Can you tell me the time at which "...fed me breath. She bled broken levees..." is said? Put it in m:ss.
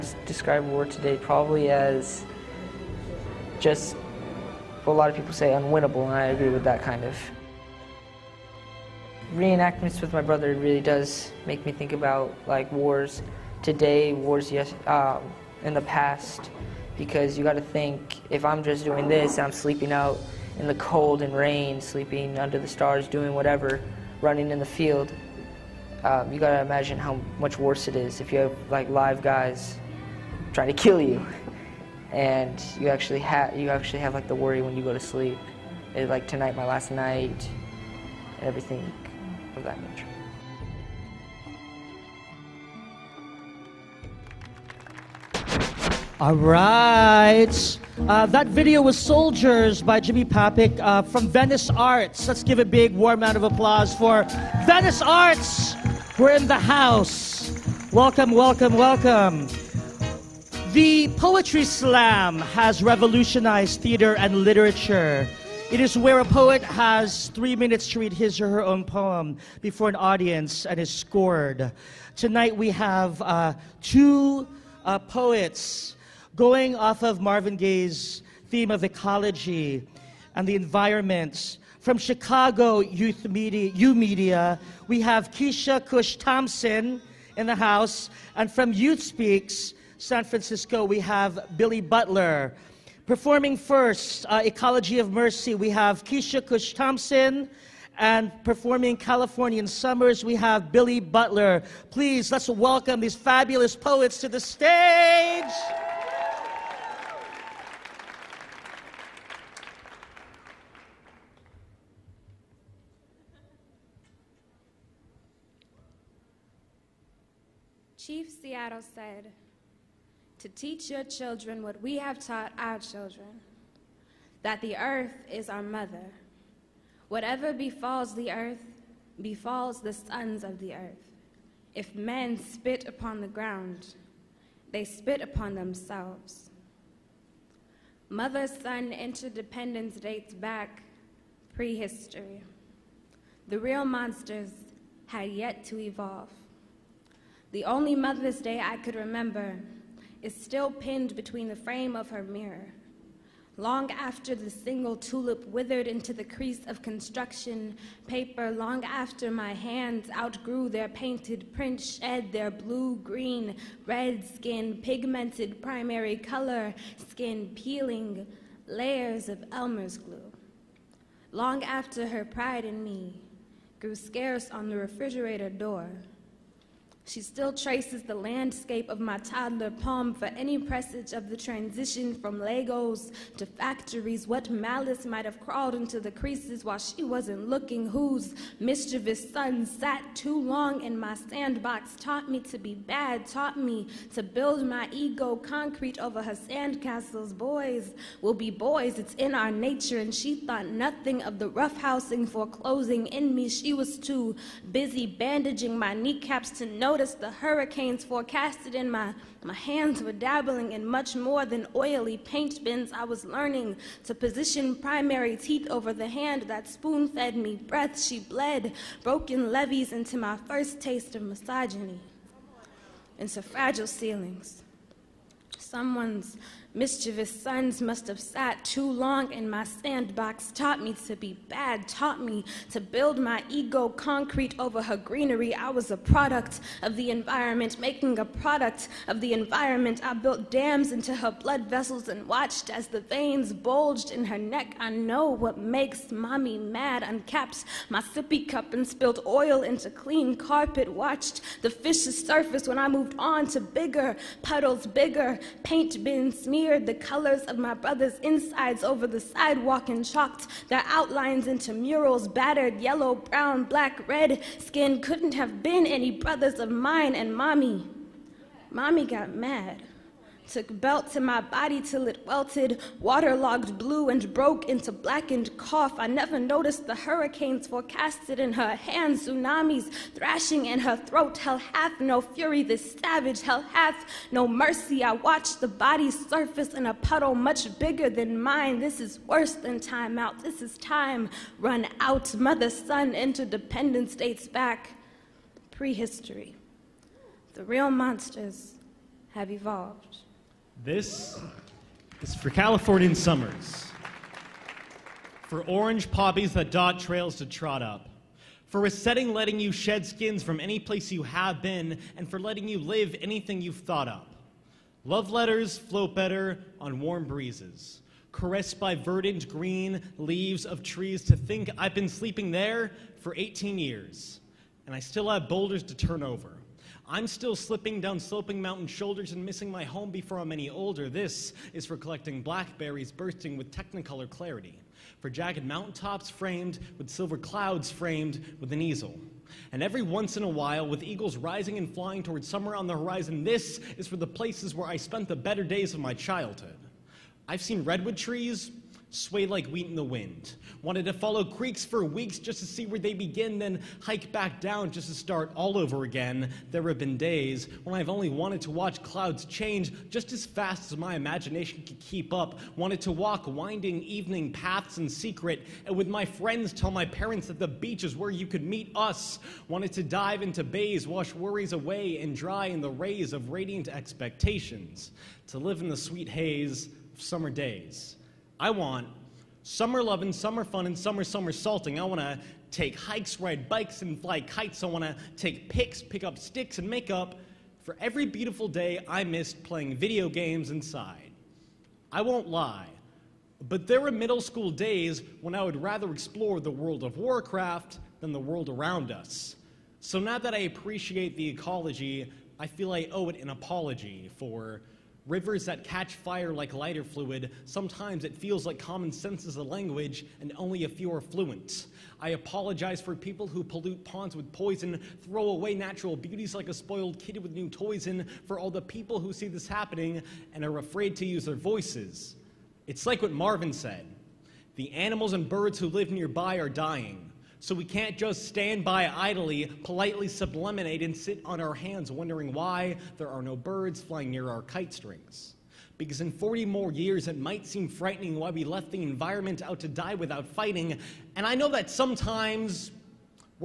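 3:37.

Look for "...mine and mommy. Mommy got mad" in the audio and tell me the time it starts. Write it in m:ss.
4:26.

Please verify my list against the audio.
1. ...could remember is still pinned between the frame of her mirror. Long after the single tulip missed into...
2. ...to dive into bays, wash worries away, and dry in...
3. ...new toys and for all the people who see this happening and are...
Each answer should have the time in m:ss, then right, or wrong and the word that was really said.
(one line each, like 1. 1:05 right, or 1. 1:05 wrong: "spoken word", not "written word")
1. 2:28 wrong: "withered", not "missed"
2. 6:09 right
3. 6:57 right.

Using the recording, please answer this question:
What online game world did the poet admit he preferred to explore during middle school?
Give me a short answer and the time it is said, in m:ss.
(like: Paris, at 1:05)
Warcraft, at 6:37.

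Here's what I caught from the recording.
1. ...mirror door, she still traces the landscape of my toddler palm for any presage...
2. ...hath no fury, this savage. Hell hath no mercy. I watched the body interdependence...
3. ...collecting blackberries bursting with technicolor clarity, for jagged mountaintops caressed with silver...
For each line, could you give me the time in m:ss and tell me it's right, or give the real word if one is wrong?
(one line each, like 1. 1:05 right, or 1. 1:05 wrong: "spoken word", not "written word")
1. 2:54 wrong: "refrigerator", not "mirror"
2. 4:41 wrong: "surface", not "interdependence"
3. 5:31 wrong: "framed", not "caressed".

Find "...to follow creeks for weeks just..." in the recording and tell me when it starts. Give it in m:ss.
5:51.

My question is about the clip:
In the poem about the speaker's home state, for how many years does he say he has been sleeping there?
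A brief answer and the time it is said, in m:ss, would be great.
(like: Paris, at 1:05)
18, at 5:23.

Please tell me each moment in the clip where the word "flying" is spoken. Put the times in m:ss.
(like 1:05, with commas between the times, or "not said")
5:41, 7:14.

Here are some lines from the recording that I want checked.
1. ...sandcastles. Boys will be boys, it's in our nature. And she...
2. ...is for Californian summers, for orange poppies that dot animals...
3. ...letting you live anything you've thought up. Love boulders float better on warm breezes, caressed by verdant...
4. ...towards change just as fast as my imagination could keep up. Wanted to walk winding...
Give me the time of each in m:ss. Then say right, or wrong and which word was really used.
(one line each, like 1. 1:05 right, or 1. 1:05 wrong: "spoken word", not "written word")
1. 3:16 right
2. 5:02 wrong: "trails", not "animals"
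3. 5:12 wrong: "letters", not "boulders"
4. 5:59 wrong: "clouds", not "towards".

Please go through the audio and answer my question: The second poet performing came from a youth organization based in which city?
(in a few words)
San Francisco.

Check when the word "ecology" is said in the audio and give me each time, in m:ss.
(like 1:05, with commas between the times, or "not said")
1:18, 1:34, 6:41.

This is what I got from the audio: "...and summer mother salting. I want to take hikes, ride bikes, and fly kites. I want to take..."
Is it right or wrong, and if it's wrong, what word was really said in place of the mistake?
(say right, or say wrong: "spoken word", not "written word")
wrong: "summer", not "mother".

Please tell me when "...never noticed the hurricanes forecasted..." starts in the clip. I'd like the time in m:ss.
4:36.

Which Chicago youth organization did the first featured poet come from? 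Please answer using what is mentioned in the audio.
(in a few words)
YOUmedia.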